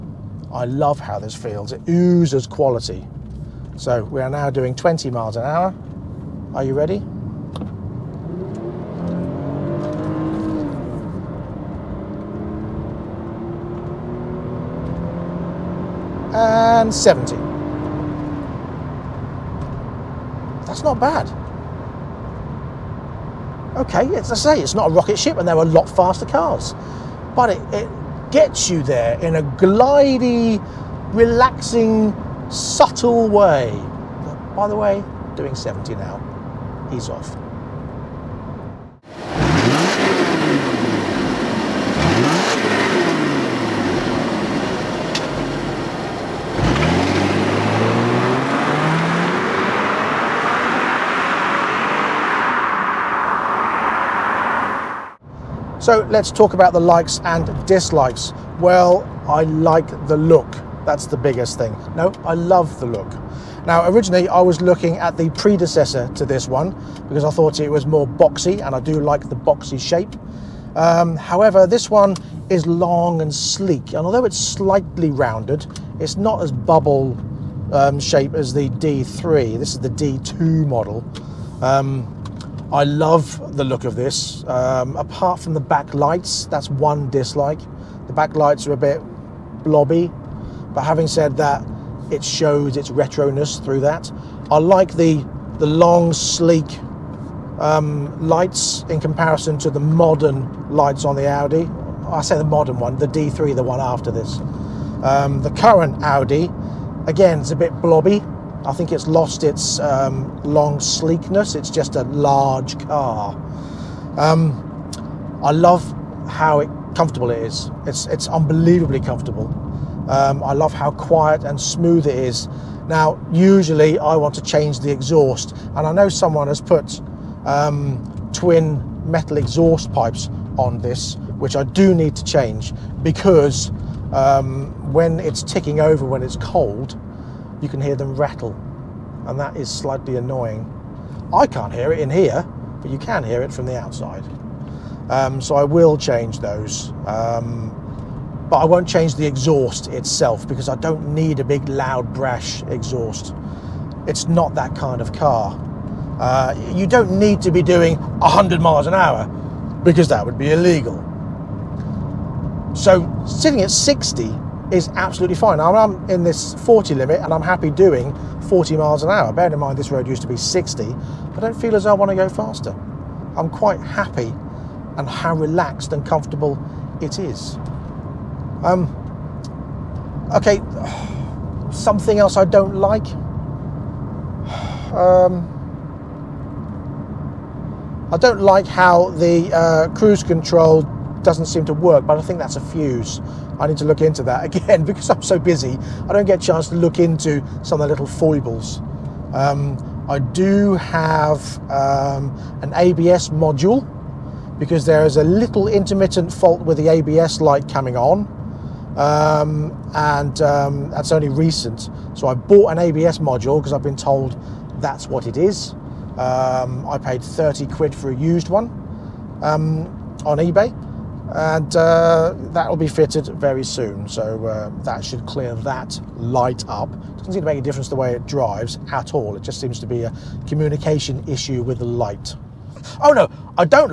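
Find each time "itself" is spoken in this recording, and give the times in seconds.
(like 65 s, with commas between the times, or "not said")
149 s.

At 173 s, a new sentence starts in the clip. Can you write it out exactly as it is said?
I'm quite happy and how relaxed and comfortable it is.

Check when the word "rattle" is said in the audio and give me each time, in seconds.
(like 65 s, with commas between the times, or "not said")
138 s.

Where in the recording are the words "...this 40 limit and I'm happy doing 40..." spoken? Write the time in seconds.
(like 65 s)
166 s.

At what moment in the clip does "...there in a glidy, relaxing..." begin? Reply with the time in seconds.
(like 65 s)
28 s.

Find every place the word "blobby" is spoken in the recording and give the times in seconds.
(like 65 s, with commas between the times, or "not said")
89 s, 107 s.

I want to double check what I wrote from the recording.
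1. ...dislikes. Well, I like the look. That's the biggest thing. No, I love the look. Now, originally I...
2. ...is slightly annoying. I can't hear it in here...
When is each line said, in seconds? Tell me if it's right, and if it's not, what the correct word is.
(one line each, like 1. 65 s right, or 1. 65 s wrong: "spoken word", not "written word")
1. 57 s right
2. 139 s right.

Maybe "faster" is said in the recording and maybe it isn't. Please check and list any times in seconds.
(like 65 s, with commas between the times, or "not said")
25 s, 172 s.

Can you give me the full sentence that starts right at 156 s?
Uh, you don't need to be doing 100 miles an hour because that would be illegal.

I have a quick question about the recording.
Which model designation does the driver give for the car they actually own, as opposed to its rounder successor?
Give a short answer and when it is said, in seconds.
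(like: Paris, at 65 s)
D2, at 79 s.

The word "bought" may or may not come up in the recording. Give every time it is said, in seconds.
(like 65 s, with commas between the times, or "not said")
212 s.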